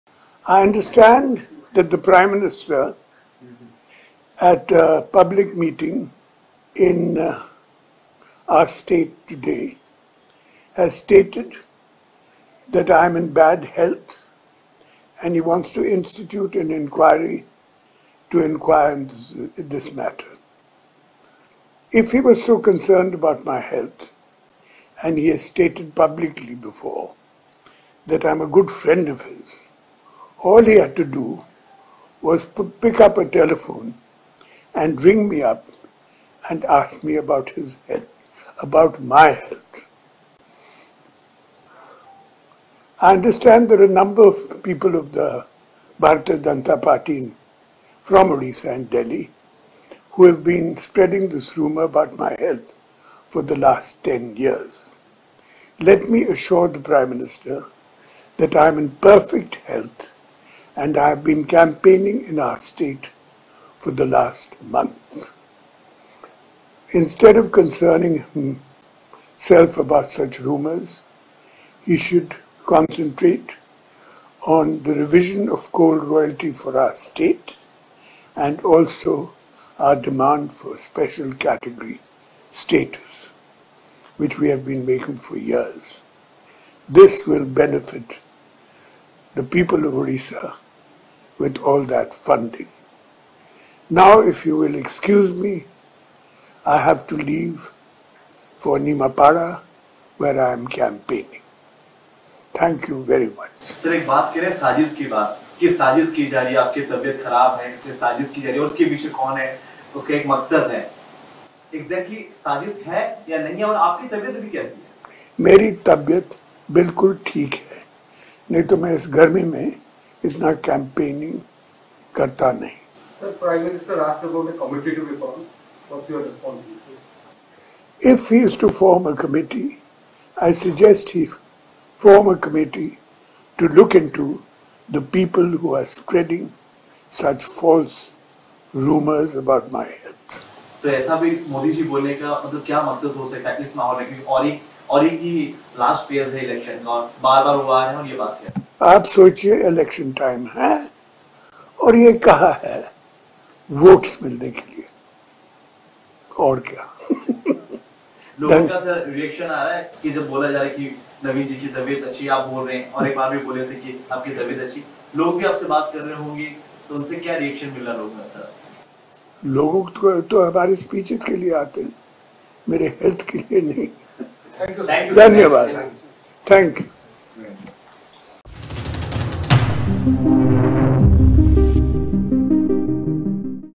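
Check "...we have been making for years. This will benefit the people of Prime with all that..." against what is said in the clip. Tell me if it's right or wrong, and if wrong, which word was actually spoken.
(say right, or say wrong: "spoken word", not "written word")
wrong: "Orissa", not "Prime".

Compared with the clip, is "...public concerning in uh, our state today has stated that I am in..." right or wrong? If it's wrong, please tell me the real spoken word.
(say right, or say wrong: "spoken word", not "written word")
wrong: "meeting", not "concerning".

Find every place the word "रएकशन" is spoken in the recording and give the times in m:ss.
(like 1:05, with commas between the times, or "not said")
2:39, 2:47.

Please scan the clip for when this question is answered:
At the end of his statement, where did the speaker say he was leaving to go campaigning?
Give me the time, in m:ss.
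1:38.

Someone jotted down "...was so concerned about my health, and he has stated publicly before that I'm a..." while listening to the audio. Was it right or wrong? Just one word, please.
right.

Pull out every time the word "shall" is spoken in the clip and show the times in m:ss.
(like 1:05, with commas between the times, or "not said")
not said.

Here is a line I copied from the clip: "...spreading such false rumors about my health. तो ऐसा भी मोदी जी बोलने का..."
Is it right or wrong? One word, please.
right.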